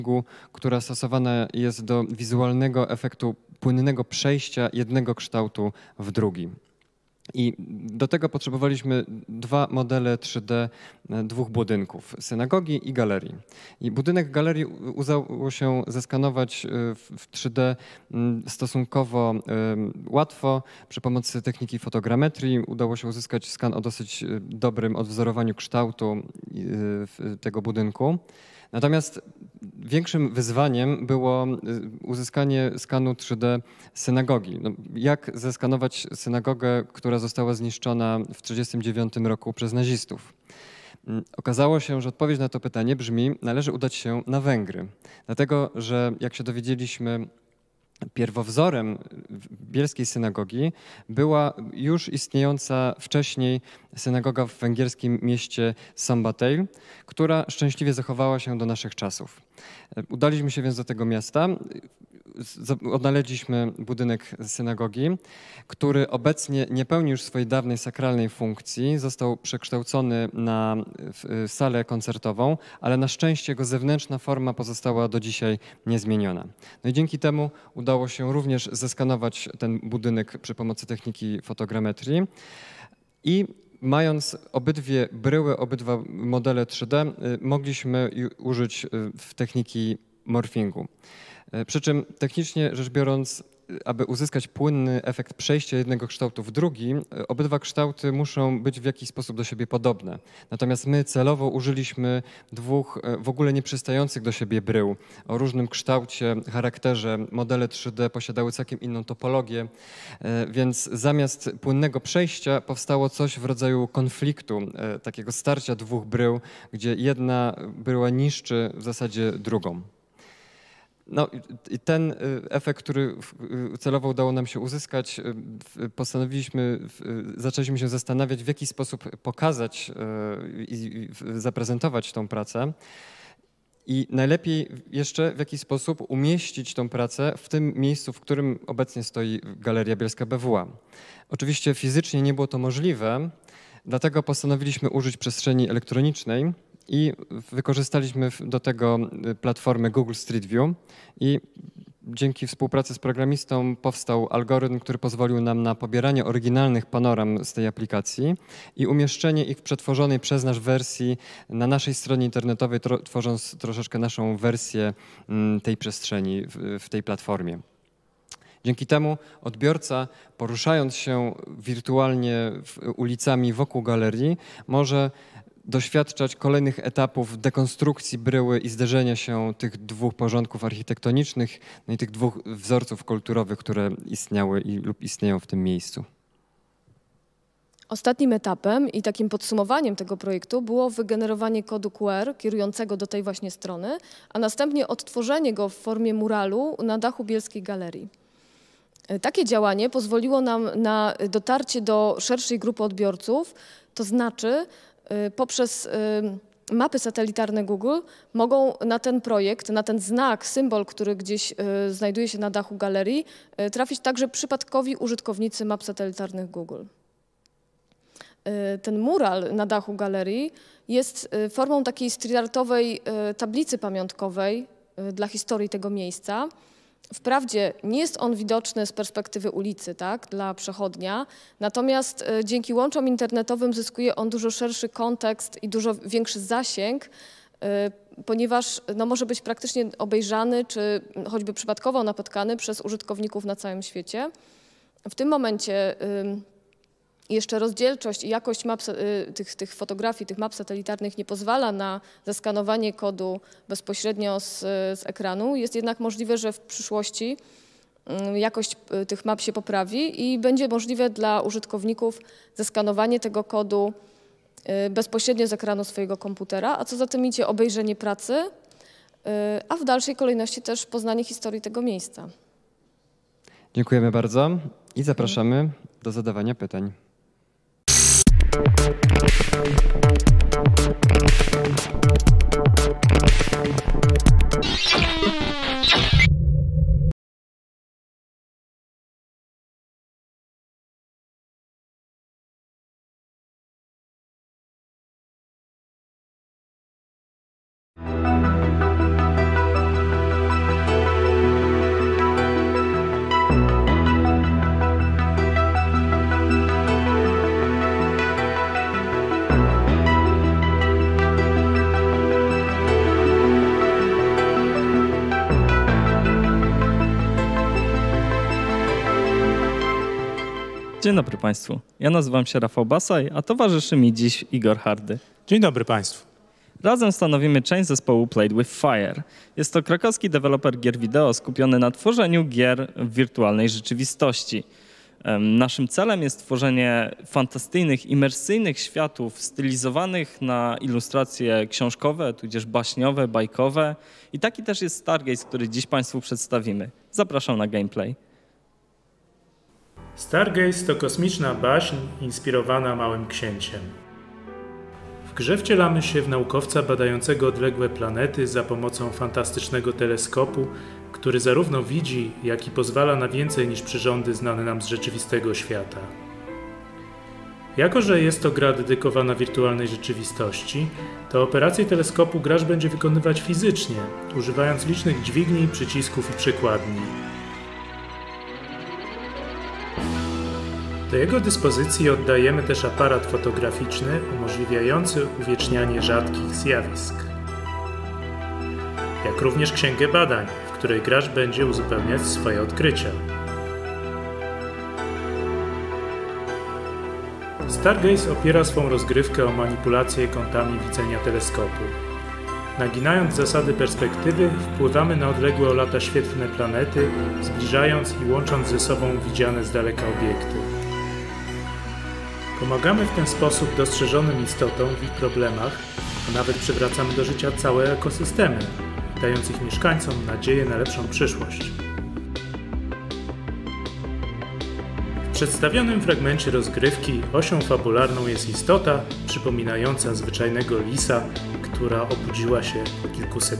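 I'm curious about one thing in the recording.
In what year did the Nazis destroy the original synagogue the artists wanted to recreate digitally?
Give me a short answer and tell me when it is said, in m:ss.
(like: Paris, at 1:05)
1939, at 0:38.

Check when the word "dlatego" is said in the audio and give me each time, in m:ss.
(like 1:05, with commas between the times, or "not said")
0:45, 2:23.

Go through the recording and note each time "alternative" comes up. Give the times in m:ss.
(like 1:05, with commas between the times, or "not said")
not said.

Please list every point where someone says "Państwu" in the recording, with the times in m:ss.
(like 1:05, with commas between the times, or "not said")
5:21, 5:25, 5:45.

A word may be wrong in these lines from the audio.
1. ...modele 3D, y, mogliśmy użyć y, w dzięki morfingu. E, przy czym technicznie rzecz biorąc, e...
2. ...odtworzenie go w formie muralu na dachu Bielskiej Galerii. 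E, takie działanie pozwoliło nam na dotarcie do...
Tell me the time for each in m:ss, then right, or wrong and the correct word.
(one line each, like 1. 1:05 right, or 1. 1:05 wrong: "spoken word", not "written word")
1. 1:26 wrong: "techniki", not "dzięki"
2. 3:14 right.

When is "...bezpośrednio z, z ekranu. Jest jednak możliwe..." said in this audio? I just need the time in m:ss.
4:13.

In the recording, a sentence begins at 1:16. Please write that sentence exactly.
No i dzięki temu udało się również zeskanować ten budynek przy pomocy techniki fotogrametrii.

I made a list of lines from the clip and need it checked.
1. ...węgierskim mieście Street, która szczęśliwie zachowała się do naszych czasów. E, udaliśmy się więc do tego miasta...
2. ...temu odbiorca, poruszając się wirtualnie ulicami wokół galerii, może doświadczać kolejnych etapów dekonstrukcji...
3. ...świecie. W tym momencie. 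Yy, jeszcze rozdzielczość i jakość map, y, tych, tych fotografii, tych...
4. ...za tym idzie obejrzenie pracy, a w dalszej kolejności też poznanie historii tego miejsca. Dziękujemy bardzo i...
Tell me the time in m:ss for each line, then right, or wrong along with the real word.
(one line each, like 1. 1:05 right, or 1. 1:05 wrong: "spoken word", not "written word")
1. 0:54 wrong: "Sambatej", not "Street"
2. 2:48 right
3. 4:03 right
4. 4:26 right.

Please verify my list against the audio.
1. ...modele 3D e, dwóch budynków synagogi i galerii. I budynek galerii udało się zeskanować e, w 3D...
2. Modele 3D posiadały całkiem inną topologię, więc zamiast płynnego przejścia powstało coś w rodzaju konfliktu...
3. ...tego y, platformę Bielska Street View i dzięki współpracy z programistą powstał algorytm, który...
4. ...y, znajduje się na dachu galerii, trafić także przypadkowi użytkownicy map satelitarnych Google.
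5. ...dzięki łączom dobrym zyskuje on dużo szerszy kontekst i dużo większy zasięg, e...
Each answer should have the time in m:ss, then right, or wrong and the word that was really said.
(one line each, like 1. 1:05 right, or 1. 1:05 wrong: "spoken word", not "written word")
1. 0:09 right
2. 1:47 right
3. 2:28 wrong: "Google", not "Bielska"
4. 3:31 right
5. 3:52 wrong: "internetowym", not "dobrym".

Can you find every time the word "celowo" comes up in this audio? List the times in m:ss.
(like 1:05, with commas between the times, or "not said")
1:41, 2:03.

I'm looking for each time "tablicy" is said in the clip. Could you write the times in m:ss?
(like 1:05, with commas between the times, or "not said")
3:43.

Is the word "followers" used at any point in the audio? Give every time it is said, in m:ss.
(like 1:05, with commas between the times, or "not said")
not said.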